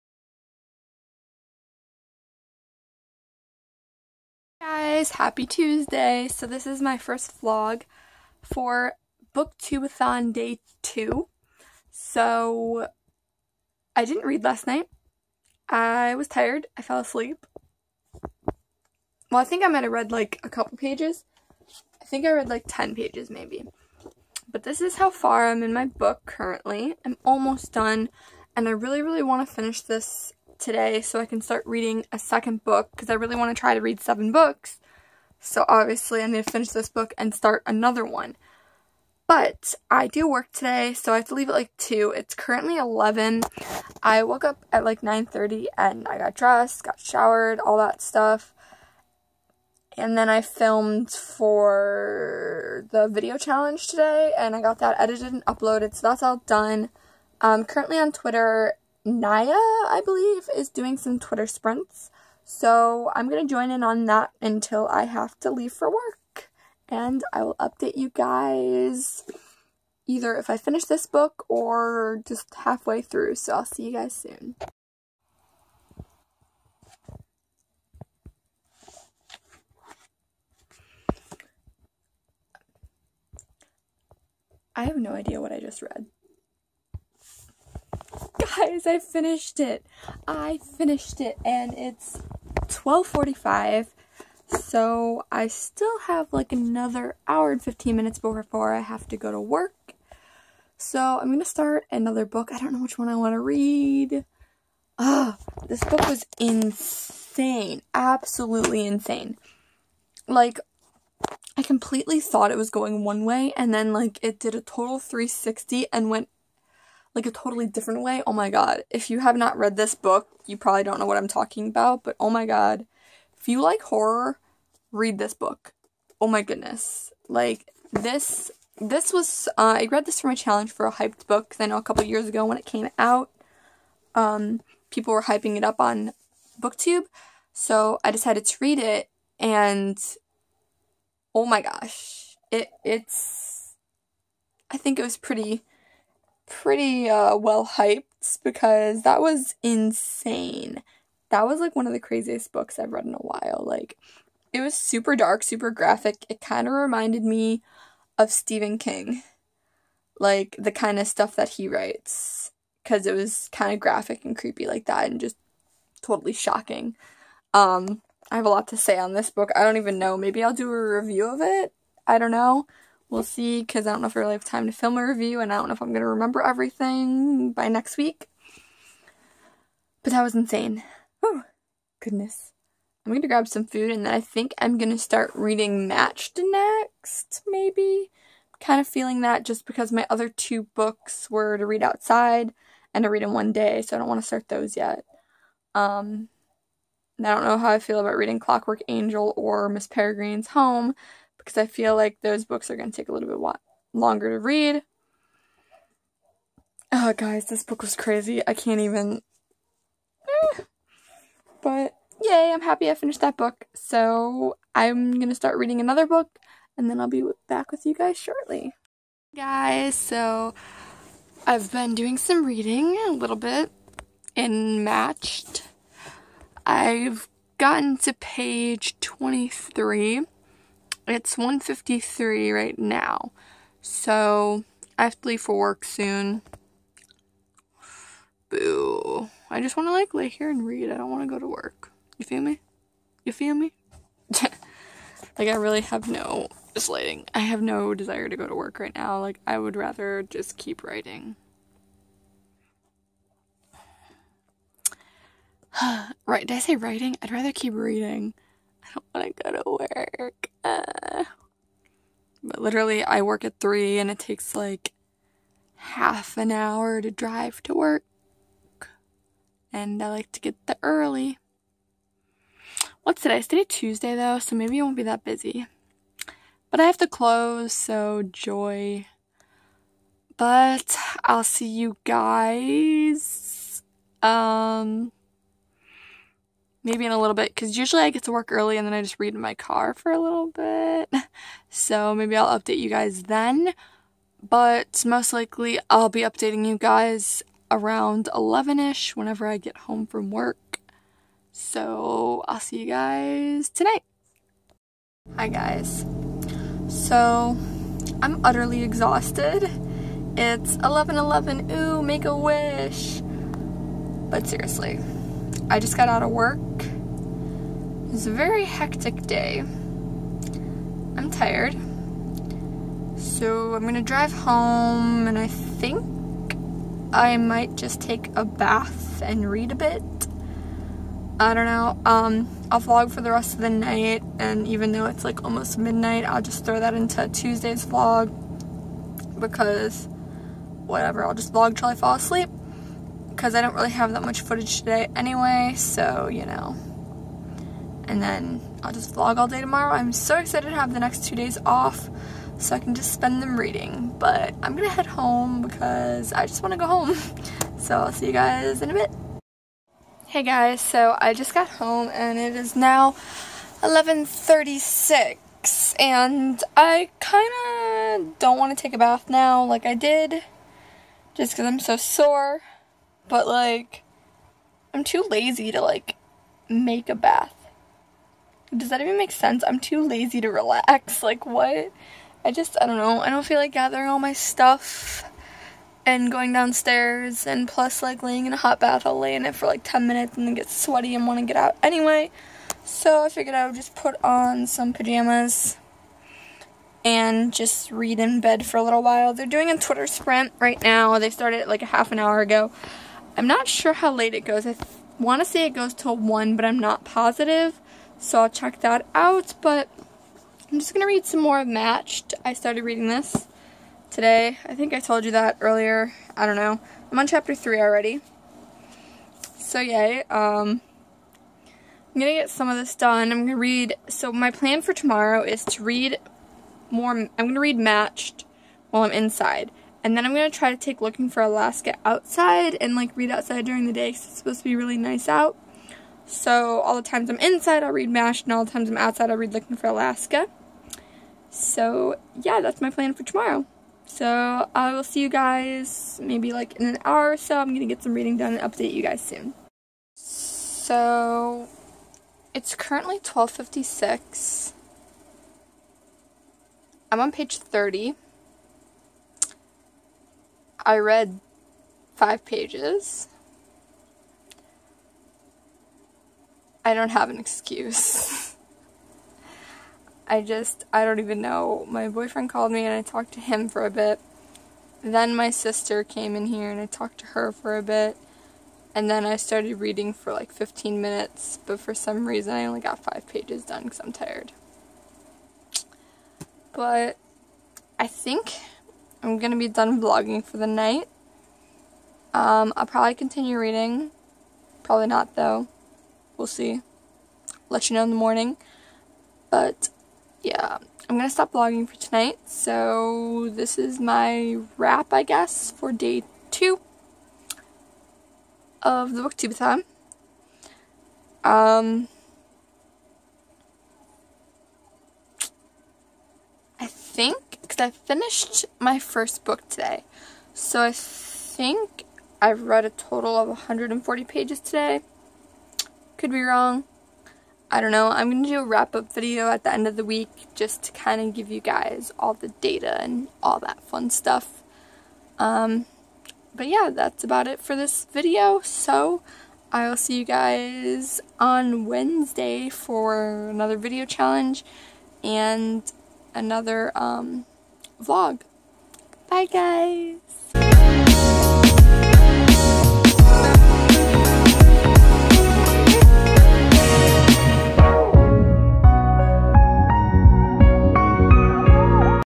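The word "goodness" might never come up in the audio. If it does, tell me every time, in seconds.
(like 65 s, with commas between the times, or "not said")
126 s, 181 s.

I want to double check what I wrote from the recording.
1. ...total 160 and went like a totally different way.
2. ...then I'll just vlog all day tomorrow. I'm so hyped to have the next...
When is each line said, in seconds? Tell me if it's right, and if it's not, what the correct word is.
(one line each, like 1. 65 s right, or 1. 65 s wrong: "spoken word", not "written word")
1. 114 s wrong: "360", not "160"
2. 348 s wrong: "excited", not "hyped".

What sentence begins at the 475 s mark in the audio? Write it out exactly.
Then my sister came in here and I talked to her for a bit.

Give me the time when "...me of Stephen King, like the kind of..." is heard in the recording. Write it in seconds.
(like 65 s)
157 s.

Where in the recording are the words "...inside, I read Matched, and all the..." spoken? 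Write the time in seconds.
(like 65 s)
437 s.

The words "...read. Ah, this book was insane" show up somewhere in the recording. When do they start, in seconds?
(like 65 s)
103 s.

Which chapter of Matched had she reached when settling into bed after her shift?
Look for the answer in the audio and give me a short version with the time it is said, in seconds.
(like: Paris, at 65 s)
3, at 417 s.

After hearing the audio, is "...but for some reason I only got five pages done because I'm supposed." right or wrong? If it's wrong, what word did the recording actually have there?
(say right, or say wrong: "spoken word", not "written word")
wrong: "tired", not "supposed".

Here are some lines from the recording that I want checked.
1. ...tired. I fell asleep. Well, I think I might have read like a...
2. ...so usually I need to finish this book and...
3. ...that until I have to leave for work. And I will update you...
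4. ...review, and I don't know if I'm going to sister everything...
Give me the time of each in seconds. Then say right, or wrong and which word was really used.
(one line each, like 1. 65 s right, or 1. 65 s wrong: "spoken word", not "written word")
1. 16 s right
2. 35 s wrong: "obviously", not "usually"
3. 64 s right
4. 175 s wrong: "remember", not "sister".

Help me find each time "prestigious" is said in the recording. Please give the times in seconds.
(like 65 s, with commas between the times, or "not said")
not said.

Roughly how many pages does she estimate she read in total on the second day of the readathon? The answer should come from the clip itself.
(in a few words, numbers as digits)
140.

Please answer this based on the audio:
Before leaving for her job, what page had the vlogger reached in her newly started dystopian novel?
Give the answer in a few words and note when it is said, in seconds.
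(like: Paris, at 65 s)
23, at 228 s.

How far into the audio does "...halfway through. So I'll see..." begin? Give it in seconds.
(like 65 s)
72 s.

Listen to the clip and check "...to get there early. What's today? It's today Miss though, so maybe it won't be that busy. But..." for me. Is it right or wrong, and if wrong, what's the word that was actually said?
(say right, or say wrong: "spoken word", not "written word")
wrong: "Tuesday", not "Miss".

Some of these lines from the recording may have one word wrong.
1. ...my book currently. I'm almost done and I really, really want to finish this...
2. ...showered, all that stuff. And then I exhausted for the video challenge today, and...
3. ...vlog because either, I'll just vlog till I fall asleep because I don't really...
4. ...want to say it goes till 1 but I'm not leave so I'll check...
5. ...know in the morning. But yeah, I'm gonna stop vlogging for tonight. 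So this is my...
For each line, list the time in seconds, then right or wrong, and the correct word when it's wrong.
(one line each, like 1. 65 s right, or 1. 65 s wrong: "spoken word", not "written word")
1. 25 s right
2. 46 s wrong: "filmed", not "exhausted"
3. 337 s wrong: "whatever", not "either"
4. 405 s wrong: "positive", not "leave"
5. 497 s right.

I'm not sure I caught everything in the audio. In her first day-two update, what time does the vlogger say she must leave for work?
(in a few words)
2.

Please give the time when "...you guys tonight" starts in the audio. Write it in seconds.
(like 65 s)
302 s.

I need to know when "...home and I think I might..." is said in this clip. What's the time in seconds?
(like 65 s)
324 s.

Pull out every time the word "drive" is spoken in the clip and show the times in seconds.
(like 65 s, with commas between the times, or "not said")
267 s, 324 s.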